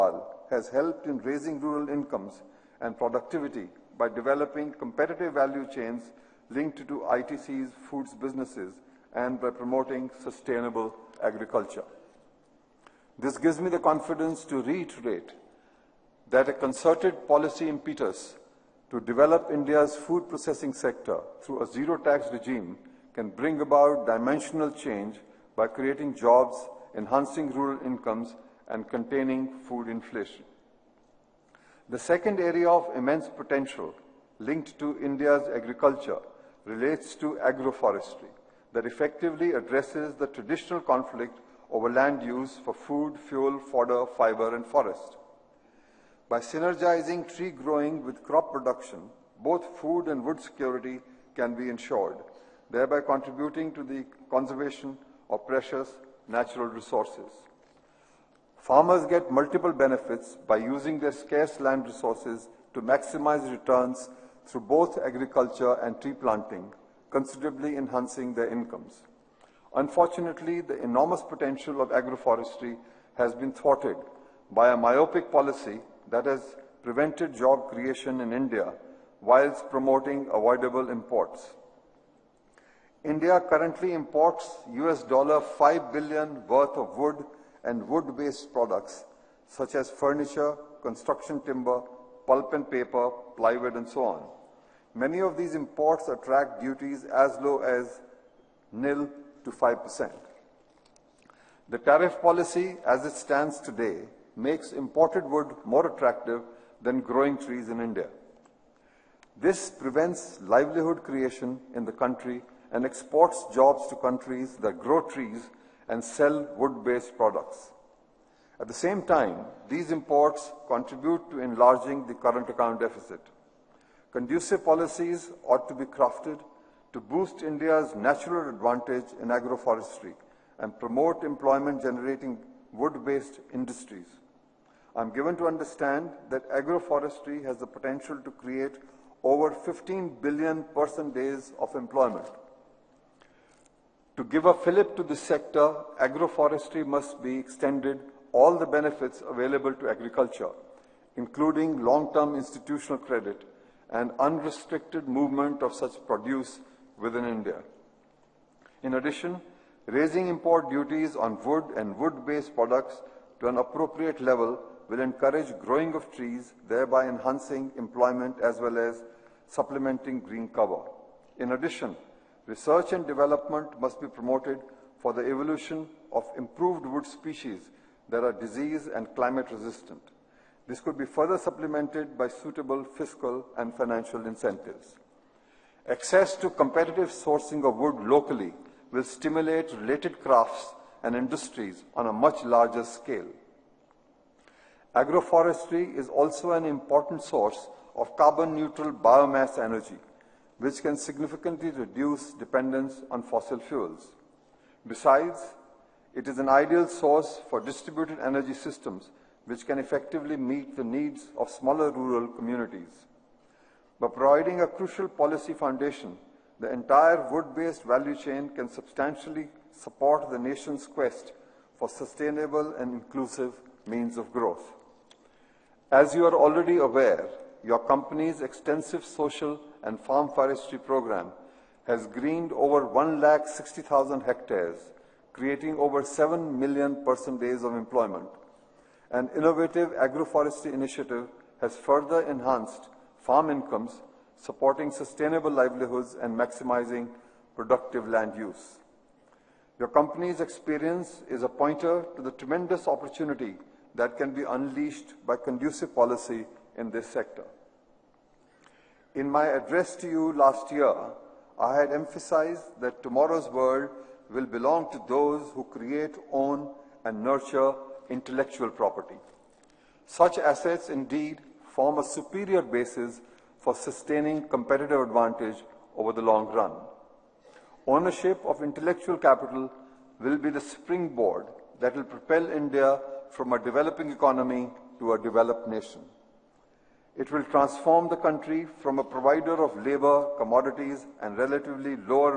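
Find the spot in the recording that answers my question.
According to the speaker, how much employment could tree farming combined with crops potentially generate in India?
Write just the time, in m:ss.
2:19.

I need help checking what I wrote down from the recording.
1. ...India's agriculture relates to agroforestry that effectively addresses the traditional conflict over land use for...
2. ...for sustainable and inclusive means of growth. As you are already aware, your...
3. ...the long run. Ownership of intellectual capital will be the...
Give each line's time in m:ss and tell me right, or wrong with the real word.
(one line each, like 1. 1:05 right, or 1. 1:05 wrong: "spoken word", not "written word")
1. 0:34 right
2. 3:41 right
3. 4:36 right.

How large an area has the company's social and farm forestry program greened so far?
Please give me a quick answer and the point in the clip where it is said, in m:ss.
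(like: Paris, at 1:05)
over 160,000 hectares, at 3:52.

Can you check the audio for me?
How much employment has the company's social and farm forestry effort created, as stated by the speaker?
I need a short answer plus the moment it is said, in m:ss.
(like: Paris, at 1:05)
over 7 million person days, at 3:55.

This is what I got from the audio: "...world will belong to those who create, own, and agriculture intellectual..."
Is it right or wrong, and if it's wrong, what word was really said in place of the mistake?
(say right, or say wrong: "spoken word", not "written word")
wrong: "nurture", not "agriculture".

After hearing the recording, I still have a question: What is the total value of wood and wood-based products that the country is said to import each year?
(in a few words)
US$5 billion.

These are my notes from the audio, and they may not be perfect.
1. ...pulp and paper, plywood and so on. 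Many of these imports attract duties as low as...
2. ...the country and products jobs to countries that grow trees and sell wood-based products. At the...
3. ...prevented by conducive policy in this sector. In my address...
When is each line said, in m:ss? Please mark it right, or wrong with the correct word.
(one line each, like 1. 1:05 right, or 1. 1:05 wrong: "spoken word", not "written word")
1. 1:32 right
2. 1:51 wrong: "exports", not "products"
3. 4:14 wrong: "unleashed", not "prevented".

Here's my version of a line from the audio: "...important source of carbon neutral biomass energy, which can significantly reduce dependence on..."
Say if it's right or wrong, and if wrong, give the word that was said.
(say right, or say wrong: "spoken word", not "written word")
right.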